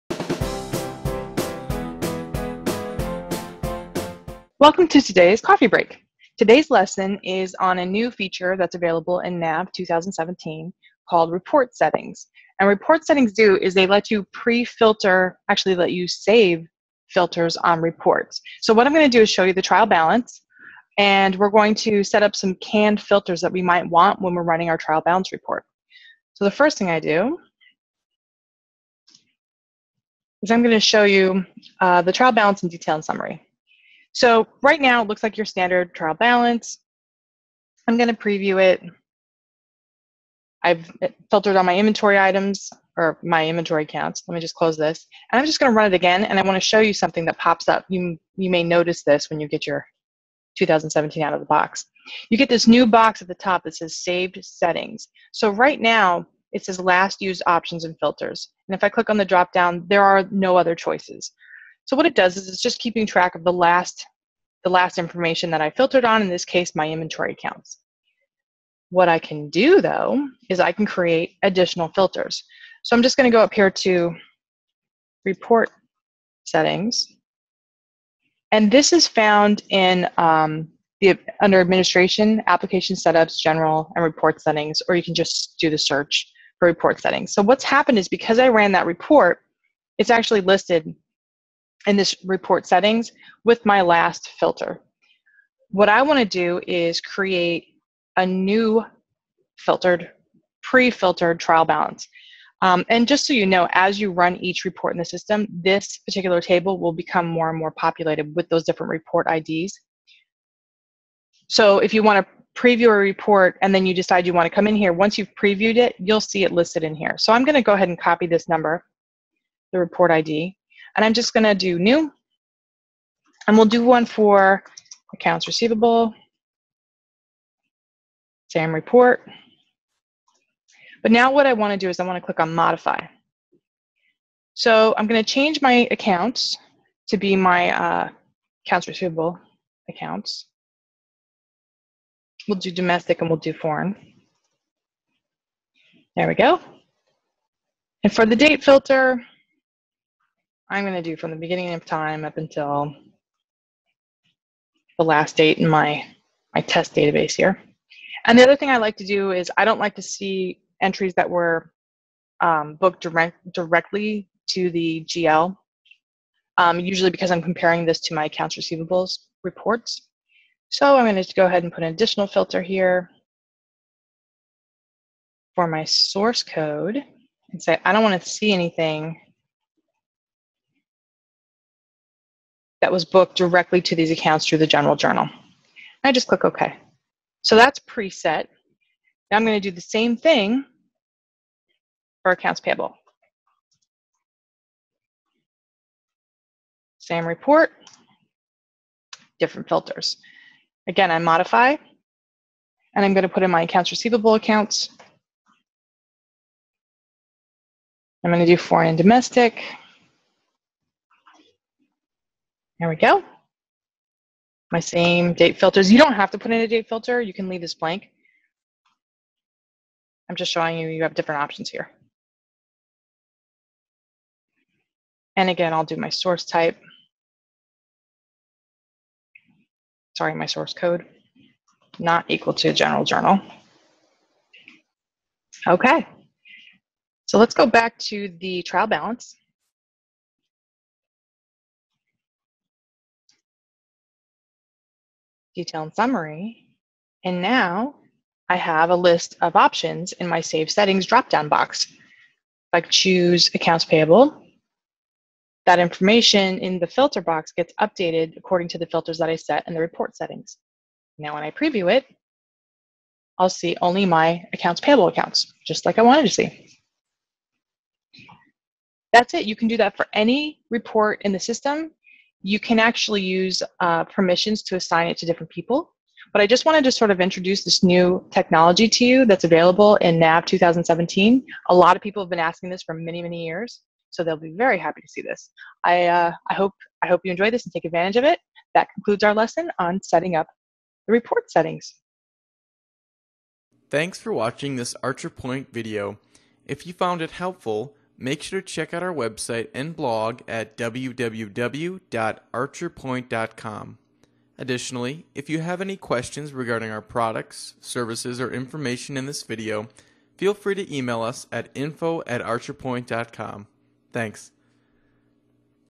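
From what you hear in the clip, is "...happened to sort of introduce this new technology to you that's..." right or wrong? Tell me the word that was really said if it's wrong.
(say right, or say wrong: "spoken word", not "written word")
wrong: "wanted", not "happened".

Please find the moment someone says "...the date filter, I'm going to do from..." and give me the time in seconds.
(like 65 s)
148 s.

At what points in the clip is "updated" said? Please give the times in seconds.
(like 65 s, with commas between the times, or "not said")
257 s.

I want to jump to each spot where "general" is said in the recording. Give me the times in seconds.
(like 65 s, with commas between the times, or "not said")
83 s, 184 s, 232 s.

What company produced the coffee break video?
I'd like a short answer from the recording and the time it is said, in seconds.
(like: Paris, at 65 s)
ArcherPoint, at 295 s.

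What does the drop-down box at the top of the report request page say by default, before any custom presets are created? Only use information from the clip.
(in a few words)
Last used options and filters.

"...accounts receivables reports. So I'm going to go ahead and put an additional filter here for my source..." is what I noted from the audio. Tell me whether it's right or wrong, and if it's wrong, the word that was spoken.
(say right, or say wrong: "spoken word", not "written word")
right.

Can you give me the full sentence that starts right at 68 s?
What I can do though, is I can create additional filters.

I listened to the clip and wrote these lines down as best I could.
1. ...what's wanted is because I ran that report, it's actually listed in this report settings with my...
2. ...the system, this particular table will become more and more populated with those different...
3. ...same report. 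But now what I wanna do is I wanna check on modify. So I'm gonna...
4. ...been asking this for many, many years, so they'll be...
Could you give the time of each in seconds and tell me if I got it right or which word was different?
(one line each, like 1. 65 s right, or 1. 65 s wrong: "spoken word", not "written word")
1. 87 s wrong: "happened", not "wanted"
2. 104 s right
3. 128 s wrong: "click", not "check"
4. 282 s right.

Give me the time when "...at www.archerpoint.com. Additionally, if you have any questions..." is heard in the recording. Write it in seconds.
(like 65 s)
300 s.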